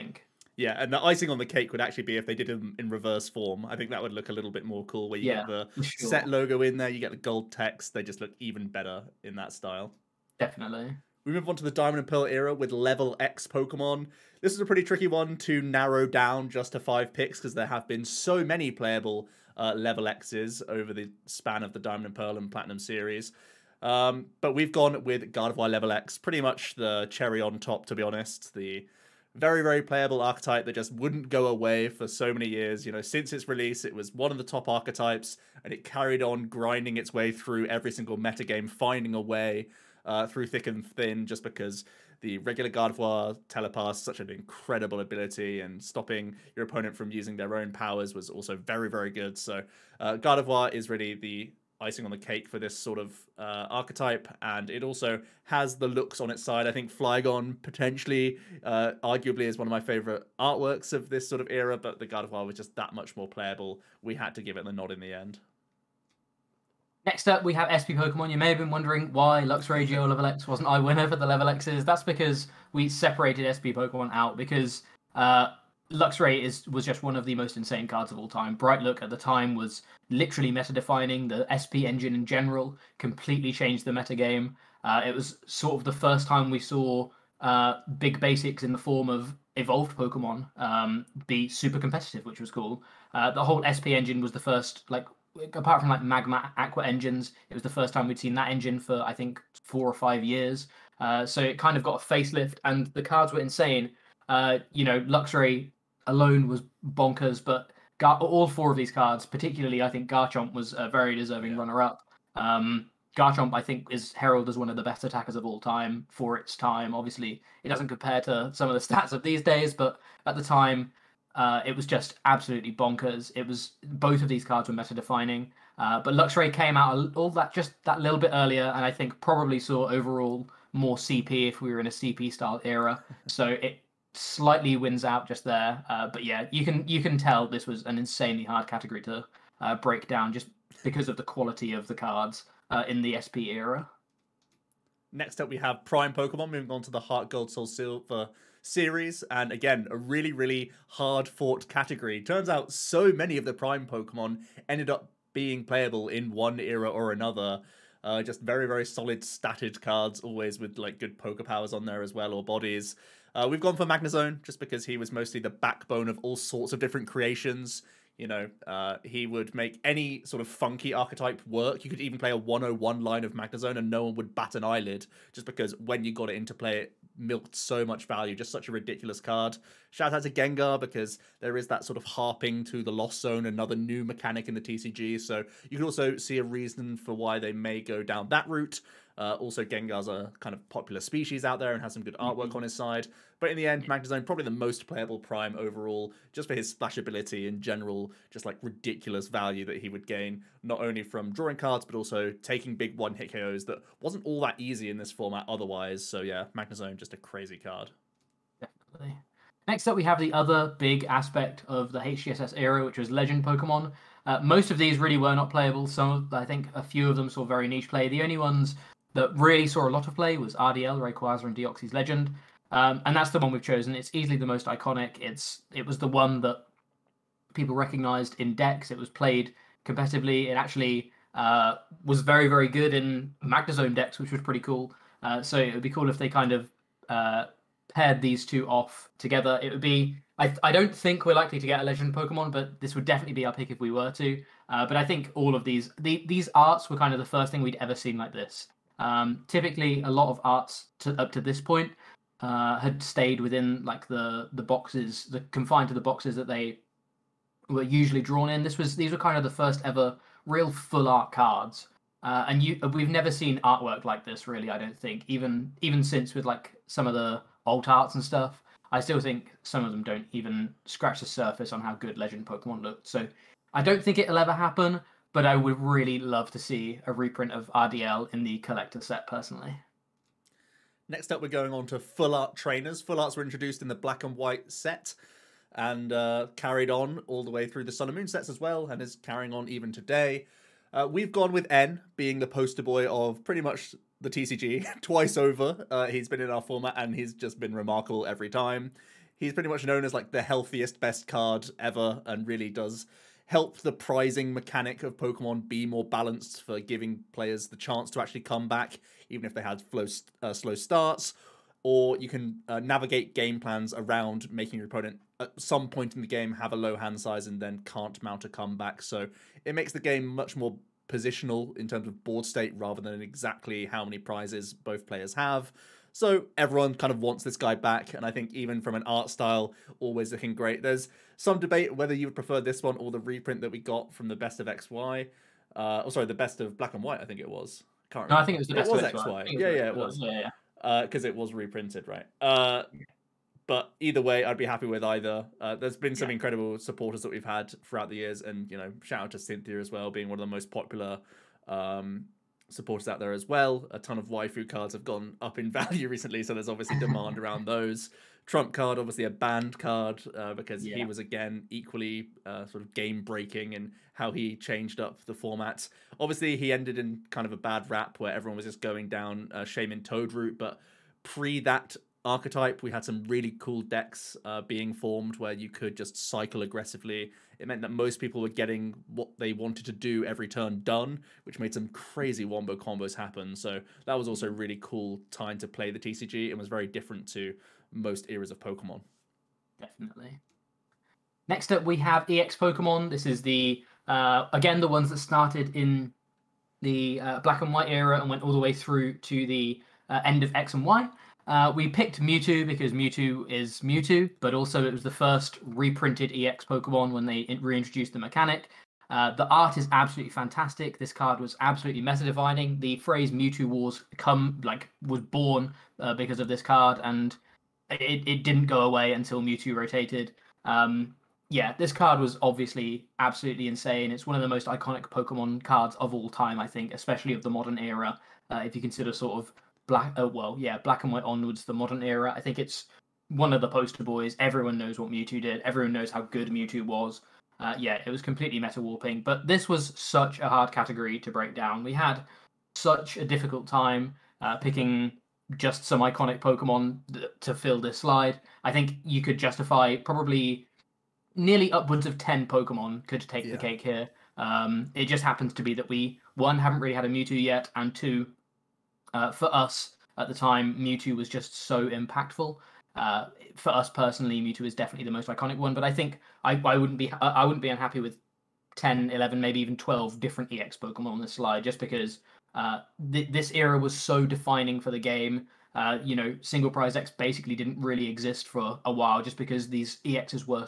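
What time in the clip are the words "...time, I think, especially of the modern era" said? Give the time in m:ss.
7:06.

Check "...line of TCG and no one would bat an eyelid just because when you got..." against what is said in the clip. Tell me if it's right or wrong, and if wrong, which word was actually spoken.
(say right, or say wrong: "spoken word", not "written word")
wrong: "Magnezone", not "TCG".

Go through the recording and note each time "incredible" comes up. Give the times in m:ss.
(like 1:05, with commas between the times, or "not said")
0:44, 5:46.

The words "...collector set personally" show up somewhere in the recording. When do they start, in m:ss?
4:38.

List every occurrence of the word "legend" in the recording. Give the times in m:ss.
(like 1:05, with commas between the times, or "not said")
3:33, 3:41, 4:01, 4:32.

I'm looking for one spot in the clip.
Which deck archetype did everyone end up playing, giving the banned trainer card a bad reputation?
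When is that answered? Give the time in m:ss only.
6:09.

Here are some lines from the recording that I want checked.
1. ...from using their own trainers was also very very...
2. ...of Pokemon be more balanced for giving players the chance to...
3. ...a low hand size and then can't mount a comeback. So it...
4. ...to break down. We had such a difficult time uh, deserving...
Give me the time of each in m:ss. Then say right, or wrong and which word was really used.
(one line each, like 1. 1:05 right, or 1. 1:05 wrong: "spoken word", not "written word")
1. 0:46 wrong: "powers", not "trainers"
2. 5:05 right
3. 5:16 right
4. 7:21 wrong: "picking", not "deserving".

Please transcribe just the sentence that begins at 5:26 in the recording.
So everyone kind of wants this guy back, and I think even from an art style, always looking great.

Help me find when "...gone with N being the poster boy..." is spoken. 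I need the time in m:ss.
4:51.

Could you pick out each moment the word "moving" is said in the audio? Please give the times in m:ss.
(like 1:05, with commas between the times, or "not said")
2:26.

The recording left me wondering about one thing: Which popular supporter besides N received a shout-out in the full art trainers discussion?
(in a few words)
Cynthia.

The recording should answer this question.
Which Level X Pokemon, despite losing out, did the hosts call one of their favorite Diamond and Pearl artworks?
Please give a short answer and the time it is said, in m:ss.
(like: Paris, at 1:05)
Flygon, at 0:56.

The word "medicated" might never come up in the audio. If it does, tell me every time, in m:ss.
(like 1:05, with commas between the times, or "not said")
not said.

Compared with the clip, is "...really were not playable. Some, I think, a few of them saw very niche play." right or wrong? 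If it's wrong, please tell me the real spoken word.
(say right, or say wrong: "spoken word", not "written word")
right.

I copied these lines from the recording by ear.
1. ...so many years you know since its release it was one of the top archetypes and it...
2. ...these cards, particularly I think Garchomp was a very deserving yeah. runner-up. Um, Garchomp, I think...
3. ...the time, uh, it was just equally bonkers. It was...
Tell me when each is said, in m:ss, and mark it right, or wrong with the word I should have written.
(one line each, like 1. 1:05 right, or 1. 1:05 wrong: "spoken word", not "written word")
1. 0:32 right
2. 1:48 right
3. 2:00 wrong: "absolutely", not "equally".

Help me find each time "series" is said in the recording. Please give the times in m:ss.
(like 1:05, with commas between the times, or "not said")
0:22, 2:28.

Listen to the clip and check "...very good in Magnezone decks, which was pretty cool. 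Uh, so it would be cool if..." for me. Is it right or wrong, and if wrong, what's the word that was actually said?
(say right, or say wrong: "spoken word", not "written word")
right.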